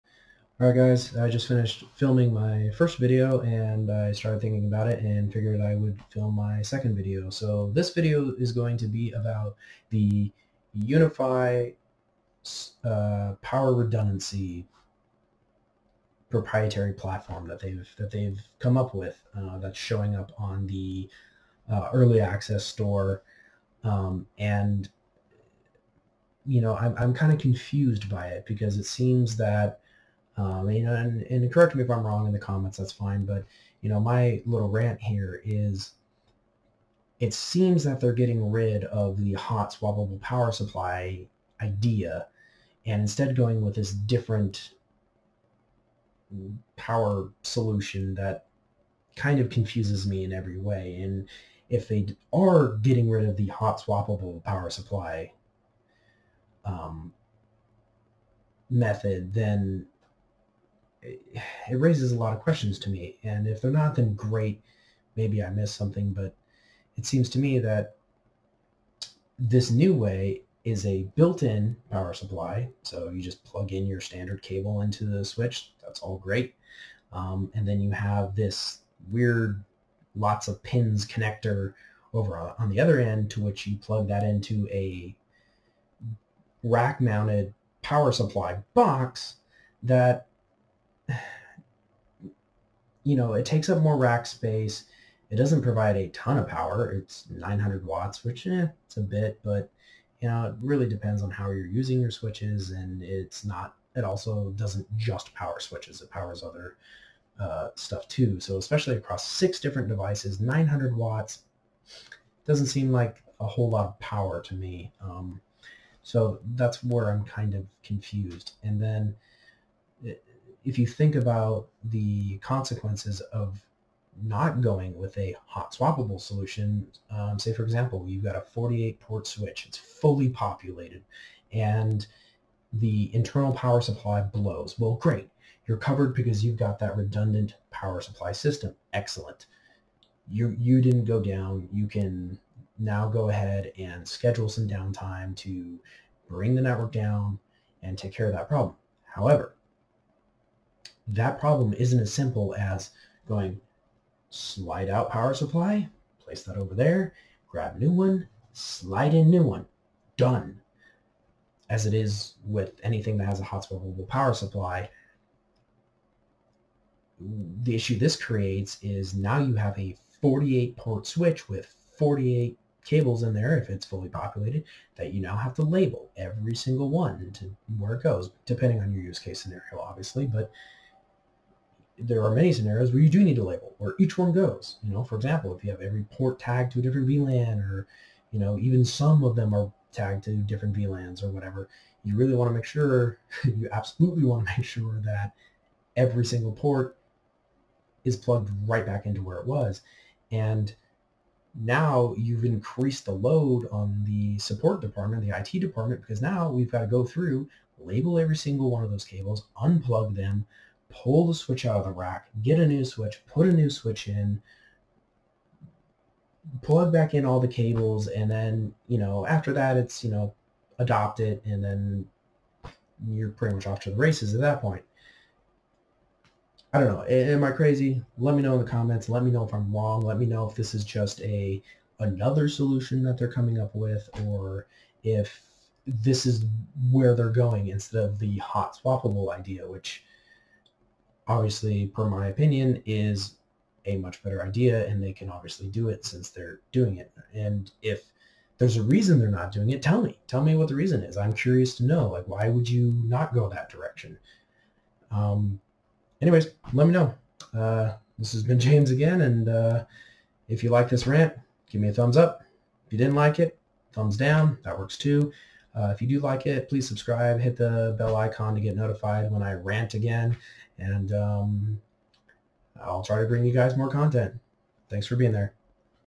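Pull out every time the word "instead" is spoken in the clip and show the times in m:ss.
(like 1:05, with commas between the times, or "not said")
0:43, 3:57.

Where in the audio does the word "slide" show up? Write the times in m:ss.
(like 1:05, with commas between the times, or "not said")
2:34, 2:38.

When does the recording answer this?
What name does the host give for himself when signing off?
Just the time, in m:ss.
4:18.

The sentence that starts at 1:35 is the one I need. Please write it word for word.
It doesn't provide a ton of power.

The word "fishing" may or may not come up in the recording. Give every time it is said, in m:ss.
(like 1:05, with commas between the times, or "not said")
not said.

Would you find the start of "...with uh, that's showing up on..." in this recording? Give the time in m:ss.
0:18.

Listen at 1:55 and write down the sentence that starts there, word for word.
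Um, so that's where I'm kind of confused.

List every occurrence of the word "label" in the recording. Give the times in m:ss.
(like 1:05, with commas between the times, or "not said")
2:55, 3:03, 3:27.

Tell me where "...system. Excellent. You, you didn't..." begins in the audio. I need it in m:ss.
2:18.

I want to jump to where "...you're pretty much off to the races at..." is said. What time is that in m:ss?
3:43.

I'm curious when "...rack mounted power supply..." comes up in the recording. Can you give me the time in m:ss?
1:26.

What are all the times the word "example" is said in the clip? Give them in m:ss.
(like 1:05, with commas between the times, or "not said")
2:07, 3:05.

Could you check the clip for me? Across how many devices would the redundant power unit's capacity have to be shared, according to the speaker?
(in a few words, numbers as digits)
6.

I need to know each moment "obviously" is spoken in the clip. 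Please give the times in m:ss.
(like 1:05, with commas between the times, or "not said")
2:59, 4:01, 4:05.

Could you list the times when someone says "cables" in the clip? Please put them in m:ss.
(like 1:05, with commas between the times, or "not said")
1:14, 2:52, 3:29, 3:37.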